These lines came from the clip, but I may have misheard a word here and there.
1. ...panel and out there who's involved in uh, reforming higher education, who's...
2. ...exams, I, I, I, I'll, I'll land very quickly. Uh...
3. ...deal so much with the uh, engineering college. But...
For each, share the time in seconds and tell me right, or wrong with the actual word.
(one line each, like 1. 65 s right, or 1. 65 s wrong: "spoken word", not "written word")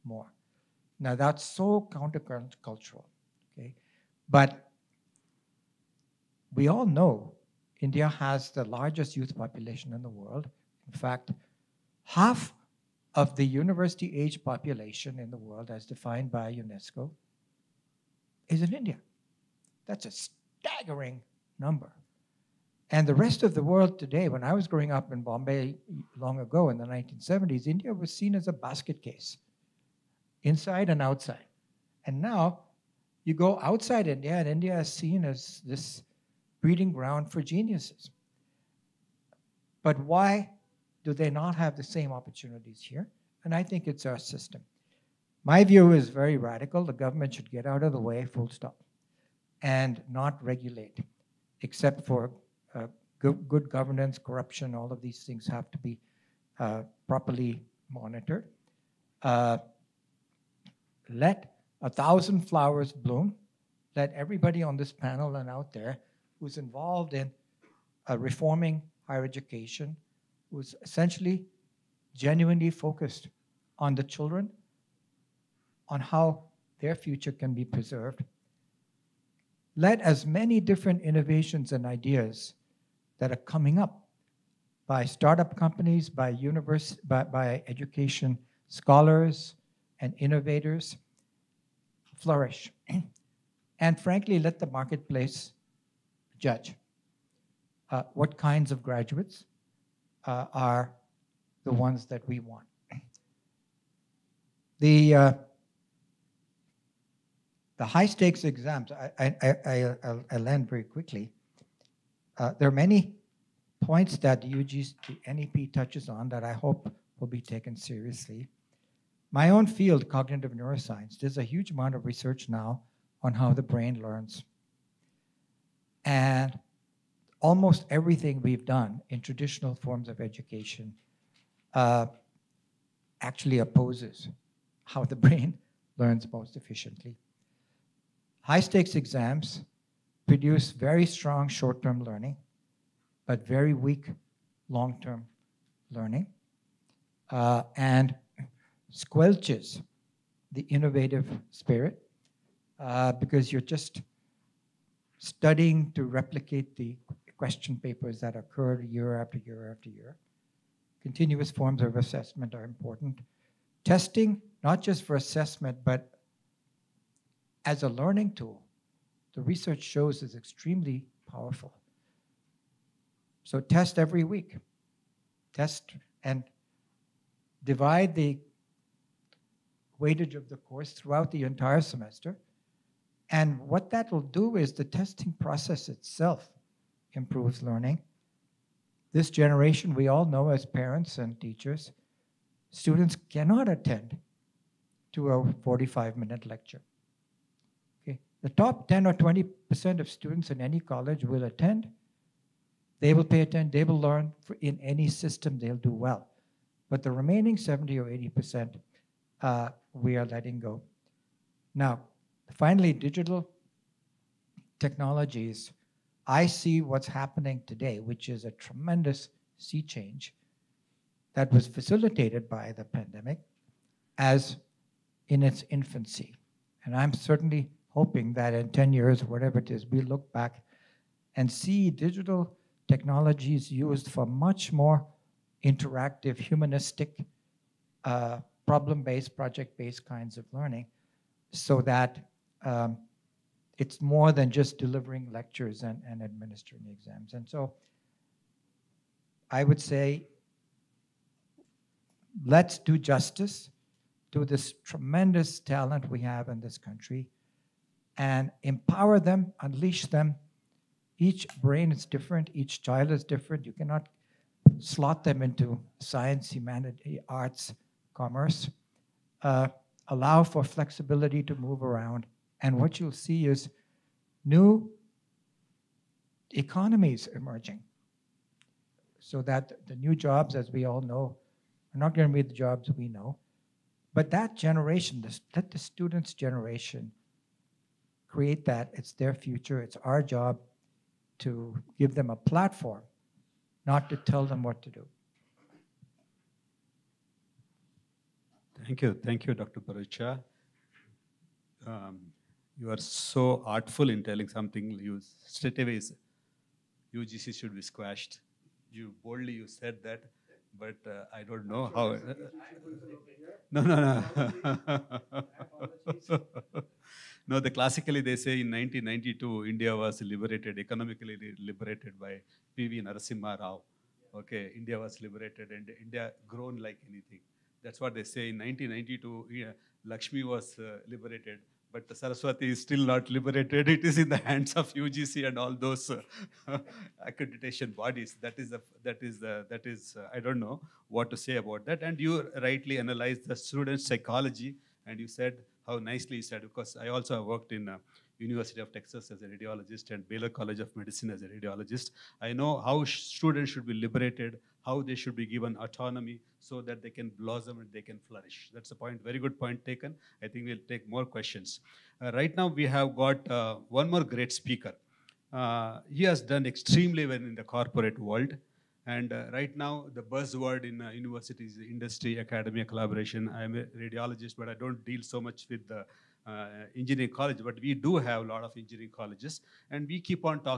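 1. 64 s right
2. 108 s right
3. 375 s right.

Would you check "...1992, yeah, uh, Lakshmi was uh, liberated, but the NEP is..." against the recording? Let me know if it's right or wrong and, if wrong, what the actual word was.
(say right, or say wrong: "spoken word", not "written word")
wrong: "Saraswati", not "NEP".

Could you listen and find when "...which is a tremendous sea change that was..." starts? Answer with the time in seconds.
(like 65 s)
217 s.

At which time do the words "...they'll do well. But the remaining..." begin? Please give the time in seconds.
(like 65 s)
205 s.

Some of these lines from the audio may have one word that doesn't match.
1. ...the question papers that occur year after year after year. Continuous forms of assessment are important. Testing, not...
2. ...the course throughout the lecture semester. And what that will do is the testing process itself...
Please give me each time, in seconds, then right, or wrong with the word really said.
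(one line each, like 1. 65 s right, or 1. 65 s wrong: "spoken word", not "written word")
1. 156 s right
2. 180 s wrong: "entire", not "lecture".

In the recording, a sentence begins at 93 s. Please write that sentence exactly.
and frankly, let the marketplace judge uh, what kinds of graduates uh, are the ones that we want.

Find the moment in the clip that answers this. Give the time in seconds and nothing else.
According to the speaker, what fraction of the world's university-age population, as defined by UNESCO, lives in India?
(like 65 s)
12 s.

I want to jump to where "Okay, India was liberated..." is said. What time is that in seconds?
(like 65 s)
324 s.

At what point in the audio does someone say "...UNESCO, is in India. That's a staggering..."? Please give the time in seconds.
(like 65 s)
16 s.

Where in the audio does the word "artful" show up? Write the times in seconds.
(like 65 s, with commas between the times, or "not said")
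303 s.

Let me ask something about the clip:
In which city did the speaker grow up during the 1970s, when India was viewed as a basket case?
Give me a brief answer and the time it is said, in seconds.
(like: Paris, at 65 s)
Bombay, at 25 s.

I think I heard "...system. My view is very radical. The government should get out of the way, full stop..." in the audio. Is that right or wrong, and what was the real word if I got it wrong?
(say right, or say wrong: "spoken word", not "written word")
right.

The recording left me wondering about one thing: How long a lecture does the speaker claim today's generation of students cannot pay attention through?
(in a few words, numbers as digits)
45 minutes.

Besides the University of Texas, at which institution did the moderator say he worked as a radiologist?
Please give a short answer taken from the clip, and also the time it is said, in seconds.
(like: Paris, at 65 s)
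Baylor College of Medicine, at 350 s.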